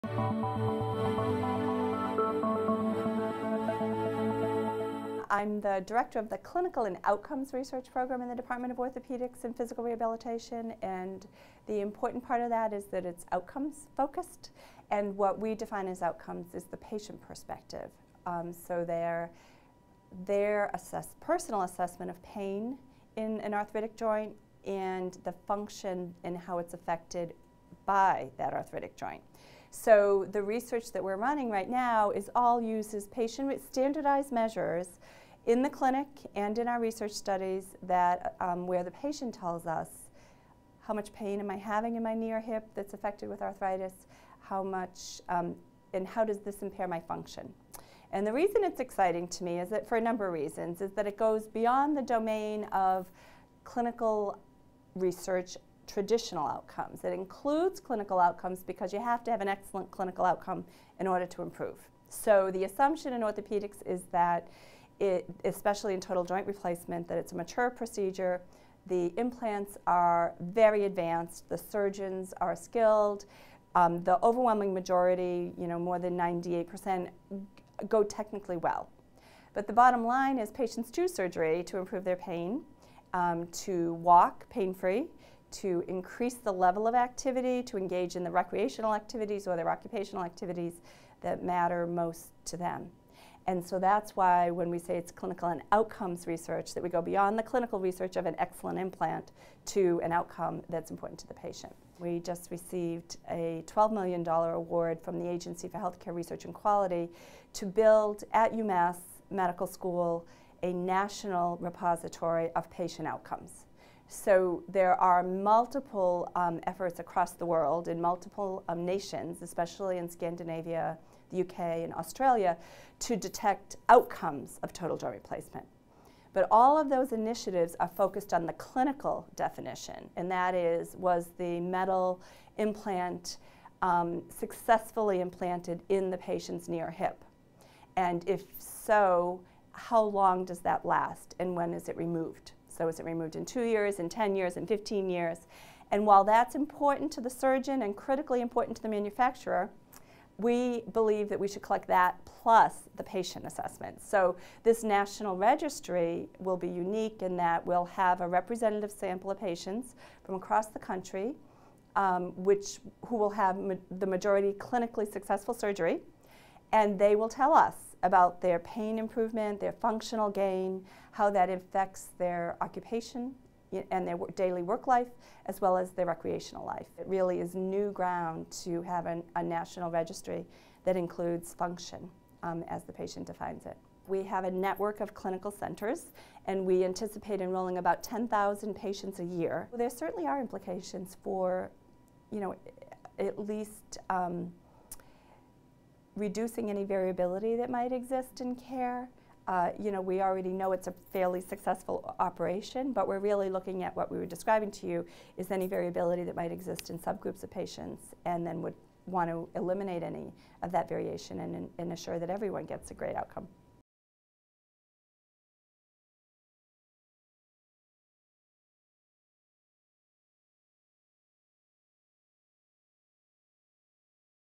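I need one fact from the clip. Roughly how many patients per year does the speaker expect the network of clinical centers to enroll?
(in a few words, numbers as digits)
10,000.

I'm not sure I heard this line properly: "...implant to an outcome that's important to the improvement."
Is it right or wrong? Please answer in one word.
wrong.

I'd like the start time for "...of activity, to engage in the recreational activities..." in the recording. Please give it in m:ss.
1:26.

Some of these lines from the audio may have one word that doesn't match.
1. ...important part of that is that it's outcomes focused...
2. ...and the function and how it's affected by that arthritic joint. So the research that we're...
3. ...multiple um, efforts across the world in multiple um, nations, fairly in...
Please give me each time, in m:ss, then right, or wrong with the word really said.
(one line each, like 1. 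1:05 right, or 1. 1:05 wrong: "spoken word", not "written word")
1. 0:11 right
2. 0:24 right
3. 1:55 wrong: "especially", not "fairly".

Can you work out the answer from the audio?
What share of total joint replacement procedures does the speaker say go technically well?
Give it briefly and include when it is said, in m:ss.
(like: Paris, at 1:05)
more than 98%, at 1:15.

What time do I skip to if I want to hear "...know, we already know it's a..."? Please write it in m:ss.
3:19.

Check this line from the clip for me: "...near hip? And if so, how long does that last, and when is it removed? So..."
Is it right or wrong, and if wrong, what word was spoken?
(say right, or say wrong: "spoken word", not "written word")
right.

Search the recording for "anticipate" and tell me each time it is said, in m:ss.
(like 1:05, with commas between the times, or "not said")
3:06.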